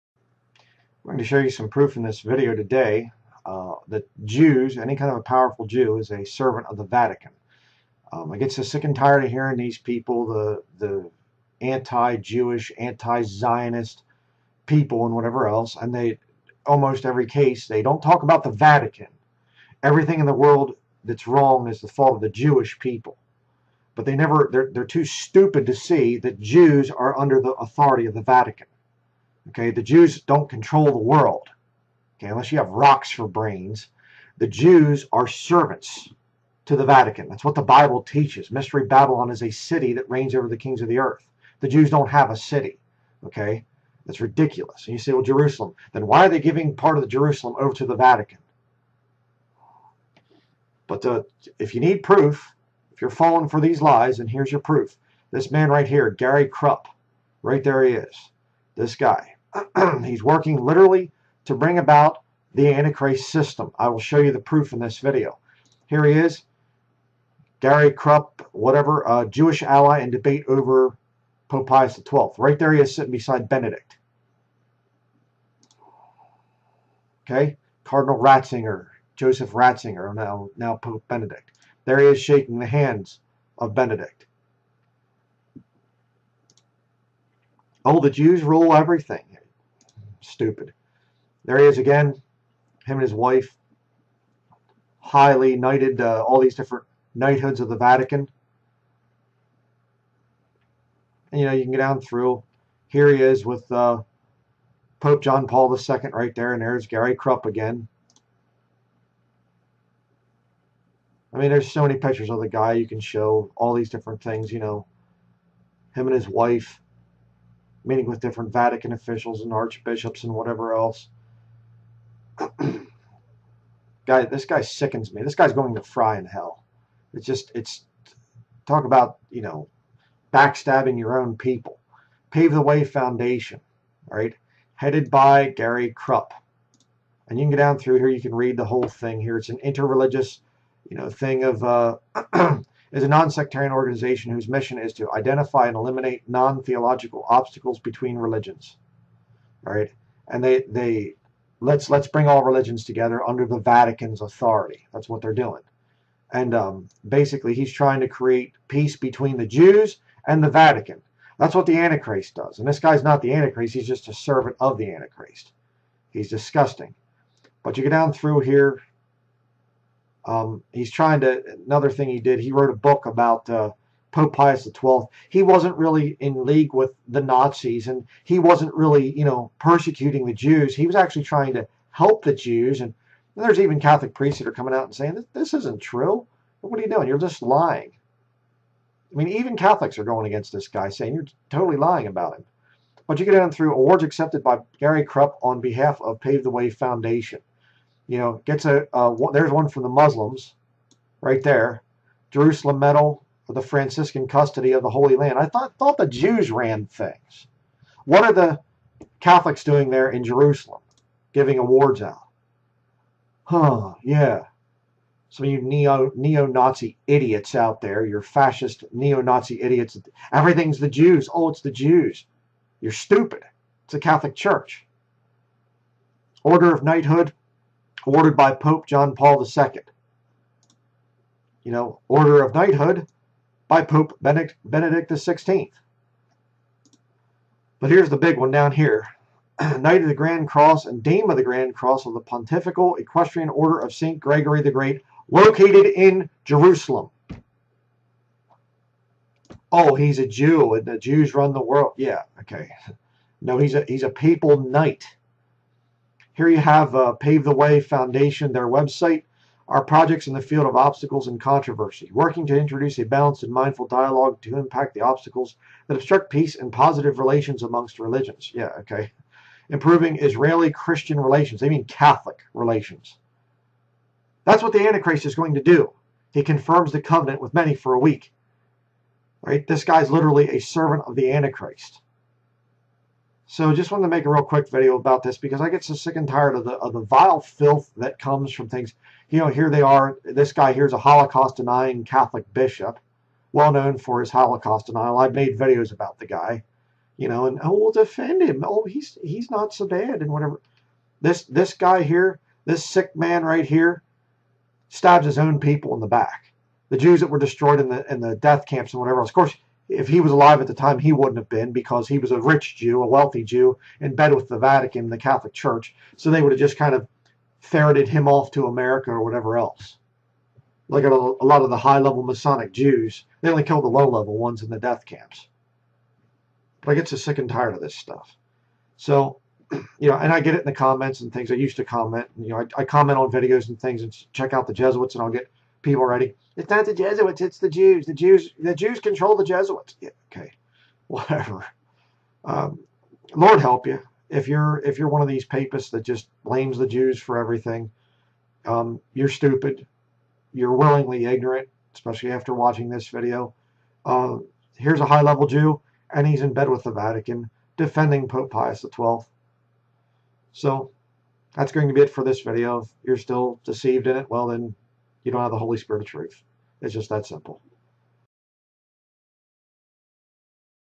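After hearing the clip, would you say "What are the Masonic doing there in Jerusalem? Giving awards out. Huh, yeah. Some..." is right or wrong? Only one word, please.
wrong.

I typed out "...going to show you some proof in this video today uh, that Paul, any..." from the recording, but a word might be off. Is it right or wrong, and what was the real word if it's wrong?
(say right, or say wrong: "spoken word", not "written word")
wrong: "Jews", not "Paul".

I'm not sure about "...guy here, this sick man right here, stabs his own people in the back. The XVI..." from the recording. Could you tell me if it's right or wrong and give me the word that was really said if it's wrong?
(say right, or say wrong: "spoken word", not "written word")
wrong: "Jews", not "XVI".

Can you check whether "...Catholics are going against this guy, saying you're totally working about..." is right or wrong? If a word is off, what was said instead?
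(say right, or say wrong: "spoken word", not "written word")
wrong: "lying", not "working".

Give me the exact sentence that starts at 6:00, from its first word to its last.
So that's going to be it for this video.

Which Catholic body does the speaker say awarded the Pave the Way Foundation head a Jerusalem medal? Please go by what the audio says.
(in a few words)
Franciscan custody of the Holy Land.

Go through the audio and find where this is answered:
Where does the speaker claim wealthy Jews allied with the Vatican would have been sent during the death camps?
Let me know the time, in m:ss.
5:18.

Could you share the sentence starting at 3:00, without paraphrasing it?
He was actually trying to help the Jews.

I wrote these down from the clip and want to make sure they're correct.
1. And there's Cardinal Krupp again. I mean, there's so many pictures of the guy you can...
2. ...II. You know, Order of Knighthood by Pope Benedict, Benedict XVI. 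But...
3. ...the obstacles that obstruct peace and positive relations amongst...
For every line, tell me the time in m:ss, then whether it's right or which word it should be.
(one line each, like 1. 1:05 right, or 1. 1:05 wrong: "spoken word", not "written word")
1. 1:46 wrong: "Gary", not "Cardinal"
2. 3:49 right
3. 4:24 right.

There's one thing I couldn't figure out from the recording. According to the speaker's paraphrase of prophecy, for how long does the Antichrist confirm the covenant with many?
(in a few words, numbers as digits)
a week.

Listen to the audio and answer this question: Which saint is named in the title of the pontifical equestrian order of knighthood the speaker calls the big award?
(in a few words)
St. Gregory the Great.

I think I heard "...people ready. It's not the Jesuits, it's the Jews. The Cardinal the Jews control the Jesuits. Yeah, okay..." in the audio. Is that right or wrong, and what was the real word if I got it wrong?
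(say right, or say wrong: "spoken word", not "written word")
wrong: "Jews", not "Cardinal".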